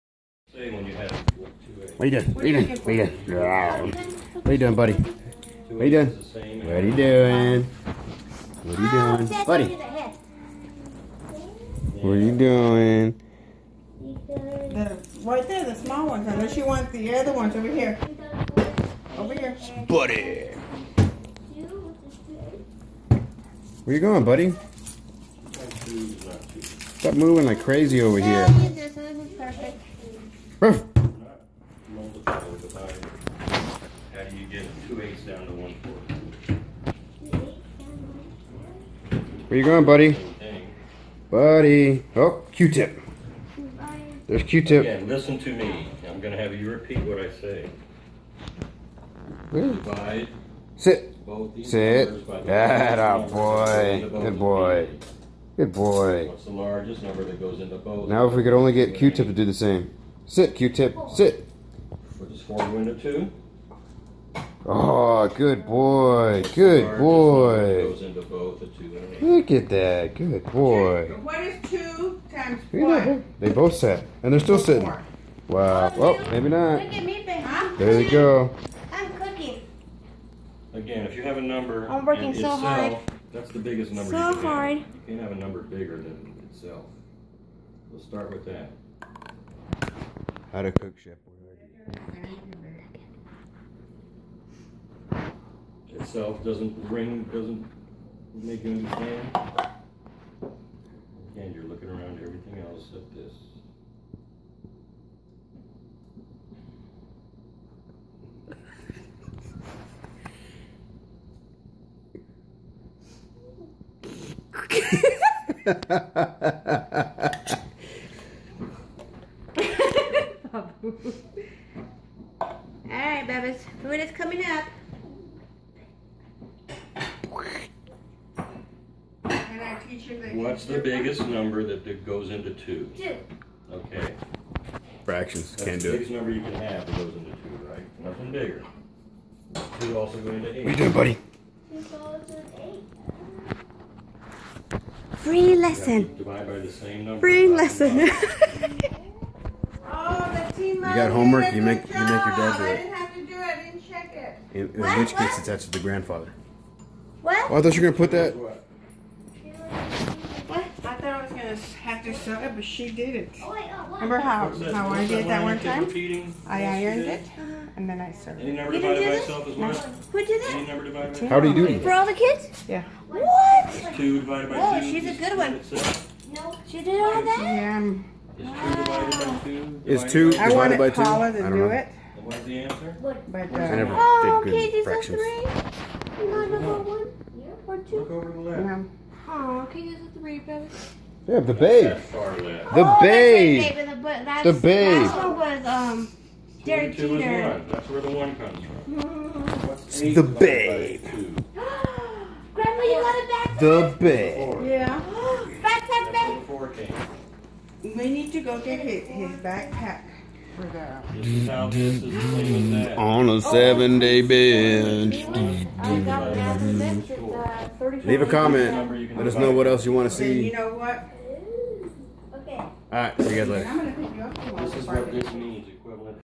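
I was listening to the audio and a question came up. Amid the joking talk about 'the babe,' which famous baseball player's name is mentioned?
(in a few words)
Derek Jeter.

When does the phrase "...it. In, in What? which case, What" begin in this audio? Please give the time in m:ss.
2:34.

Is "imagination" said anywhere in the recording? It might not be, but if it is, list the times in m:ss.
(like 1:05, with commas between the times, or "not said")
not said.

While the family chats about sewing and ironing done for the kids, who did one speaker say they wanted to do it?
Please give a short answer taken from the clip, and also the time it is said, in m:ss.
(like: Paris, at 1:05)
Paula, at 3:01.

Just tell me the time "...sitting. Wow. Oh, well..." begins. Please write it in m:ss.
1:14.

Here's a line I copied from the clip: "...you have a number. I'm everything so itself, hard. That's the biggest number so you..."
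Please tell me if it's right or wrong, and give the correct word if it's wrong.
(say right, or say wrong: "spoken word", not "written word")
wrong: "working", not "everything".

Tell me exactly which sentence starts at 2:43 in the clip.
Oh, oh, Remember how, how I did that one time?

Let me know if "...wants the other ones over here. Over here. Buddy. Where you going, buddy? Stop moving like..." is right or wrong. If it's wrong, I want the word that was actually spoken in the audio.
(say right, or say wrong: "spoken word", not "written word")
right.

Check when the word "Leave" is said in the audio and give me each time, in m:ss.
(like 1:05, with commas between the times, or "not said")
3:38.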